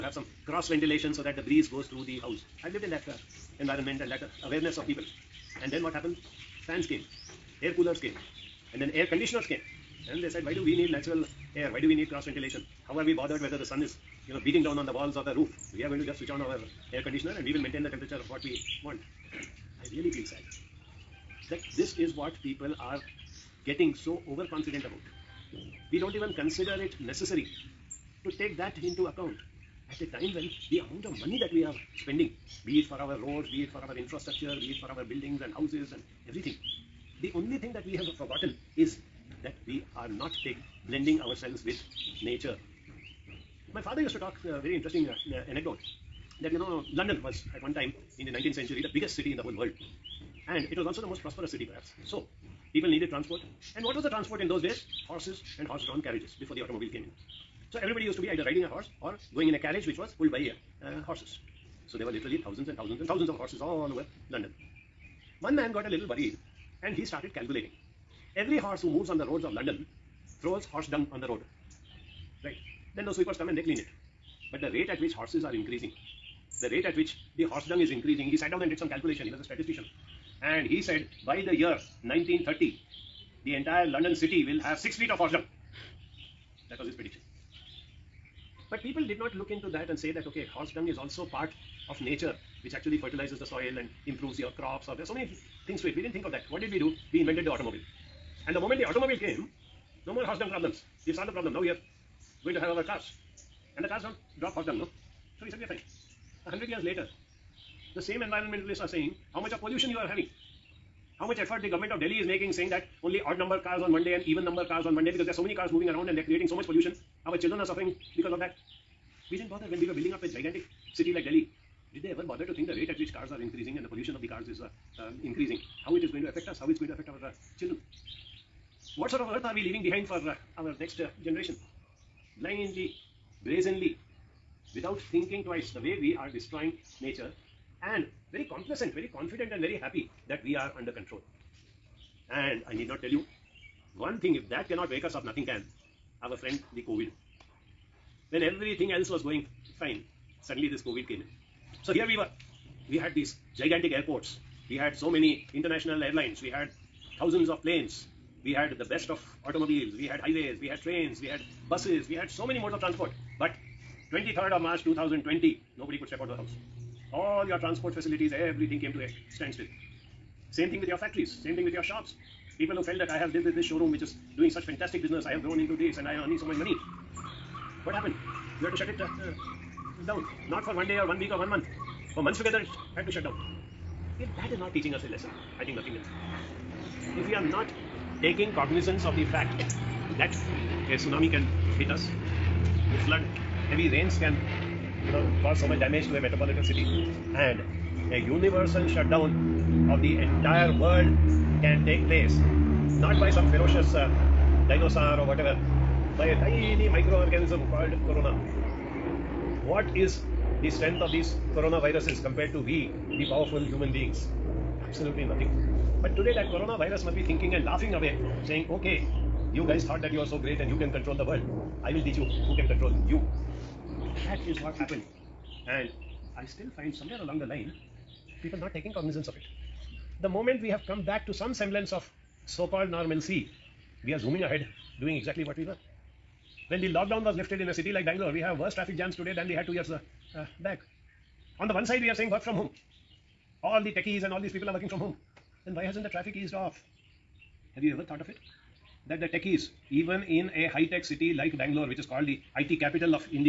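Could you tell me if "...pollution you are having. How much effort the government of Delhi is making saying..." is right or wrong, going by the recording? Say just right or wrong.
right.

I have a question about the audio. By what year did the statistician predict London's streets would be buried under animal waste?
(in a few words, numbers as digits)
1930.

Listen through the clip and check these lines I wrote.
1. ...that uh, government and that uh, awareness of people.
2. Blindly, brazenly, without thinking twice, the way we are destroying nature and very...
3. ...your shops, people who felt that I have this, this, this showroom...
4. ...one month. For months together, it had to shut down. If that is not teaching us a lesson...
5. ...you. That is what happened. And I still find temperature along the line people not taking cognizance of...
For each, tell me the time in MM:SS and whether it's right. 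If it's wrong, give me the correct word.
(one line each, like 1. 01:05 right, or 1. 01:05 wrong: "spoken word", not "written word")
1. 00:02 wrong: "environment", not "government"
2. 02:12 right
3. 02:51 right
4. 03:01 right
5. 03:43 wrong: "somewhere", not "temperature".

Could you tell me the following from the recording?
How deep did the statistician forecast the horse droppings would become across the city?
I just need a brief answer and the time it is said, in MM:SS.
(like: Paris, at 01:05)
6 feet, at 01:24.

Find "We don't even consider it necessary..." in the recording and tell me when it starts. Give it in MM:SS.
00:25.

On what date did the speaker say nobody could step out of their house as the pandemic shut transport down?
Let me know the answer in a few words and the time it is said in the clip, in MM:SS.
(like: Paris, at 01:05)
23rd of March 2020, at 02:44.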